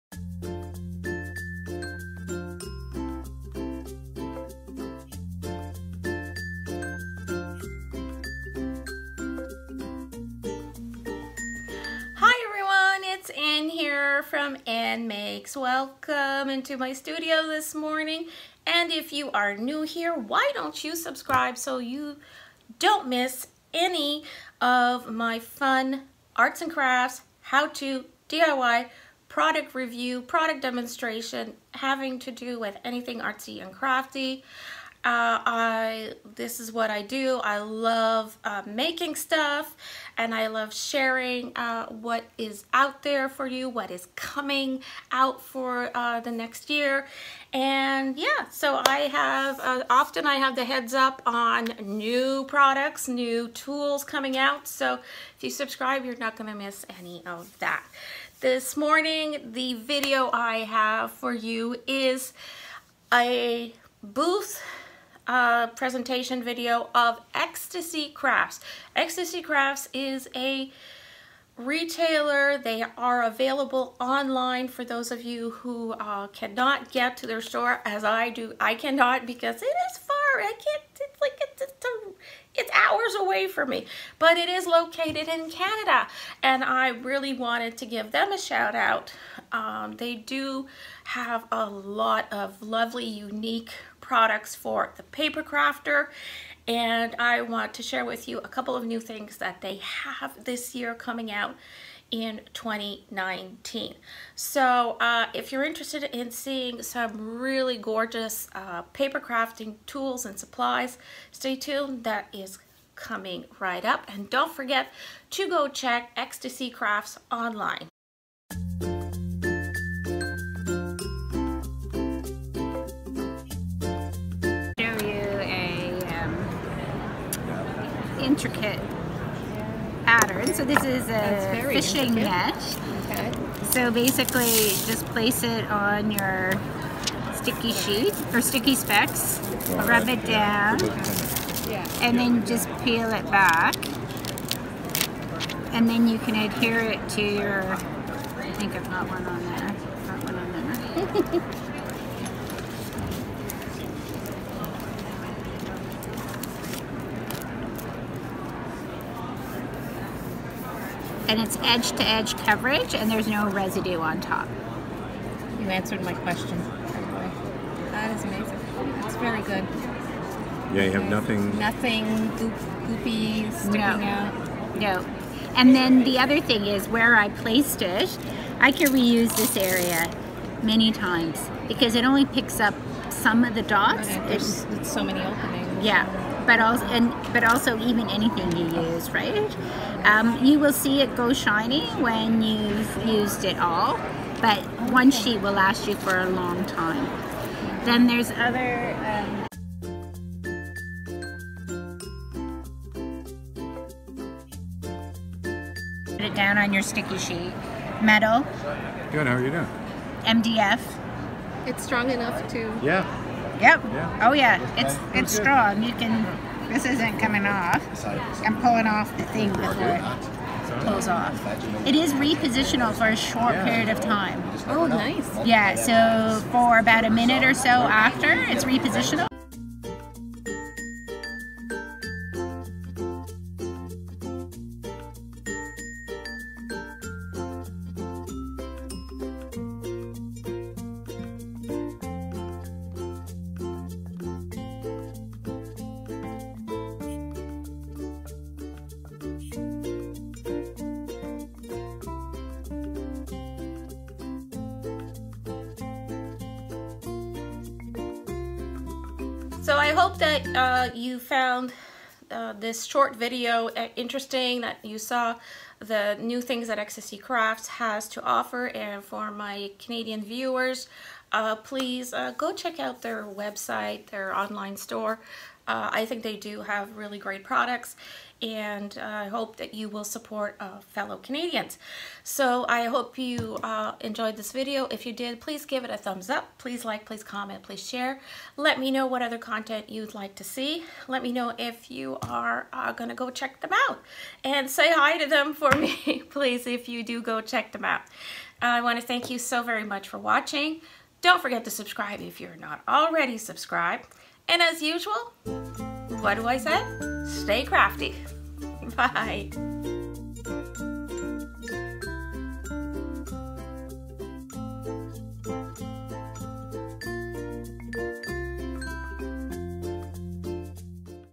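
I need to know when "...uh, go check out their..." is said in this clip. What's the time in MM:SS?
04:32.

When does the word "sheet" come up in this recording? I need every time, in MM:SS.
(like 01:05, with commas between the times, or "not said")
02:17, 03:15, 03:27.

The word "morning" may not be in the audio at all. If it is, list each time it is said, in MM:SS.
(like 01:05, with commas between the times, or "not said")
00:17, 00:58.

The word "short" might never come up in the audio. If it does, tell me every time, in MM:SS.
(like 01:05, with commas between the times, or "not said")
03:43, 04:22.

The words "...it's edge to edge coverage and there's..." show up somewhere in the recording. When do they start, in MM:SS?
02:41.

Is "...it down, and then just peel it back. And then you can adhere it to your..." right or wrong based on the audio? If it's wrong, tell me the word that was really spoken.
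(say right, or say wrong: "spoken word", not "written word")
right.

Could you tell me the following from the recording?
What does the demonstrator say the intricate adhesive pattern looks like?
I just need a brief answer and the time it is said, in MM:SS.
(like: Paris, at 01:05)
A fishing net, at 02:11.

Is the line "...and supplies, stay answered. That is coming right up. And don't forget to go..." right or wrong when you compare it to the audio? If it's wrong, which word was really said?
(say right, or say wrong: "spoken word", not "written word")
wrong: "tuned", not "answered".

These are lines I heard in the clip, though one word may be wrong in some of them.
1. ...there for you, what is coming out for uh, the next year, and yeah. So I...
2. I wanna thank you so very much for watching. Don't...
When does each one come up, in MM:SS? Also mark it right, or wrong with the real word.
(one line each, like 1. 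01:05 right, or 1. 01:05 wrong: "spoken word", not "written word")
1. 00:43 right
2. 04:58 right.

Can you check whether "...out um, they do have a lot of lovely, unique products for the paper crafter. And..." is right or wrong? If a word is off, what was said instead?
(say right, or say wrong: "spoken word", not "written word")
right.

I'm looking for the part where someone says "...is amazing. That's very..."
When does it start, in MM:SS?
02:48.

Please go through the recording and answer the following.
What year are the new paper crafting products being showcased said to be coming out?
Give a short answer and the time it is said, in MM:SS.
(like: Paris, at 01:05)
2019, at 01:42.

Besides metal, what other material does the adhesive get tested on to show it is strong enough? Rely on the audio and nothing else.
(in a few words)
MDF.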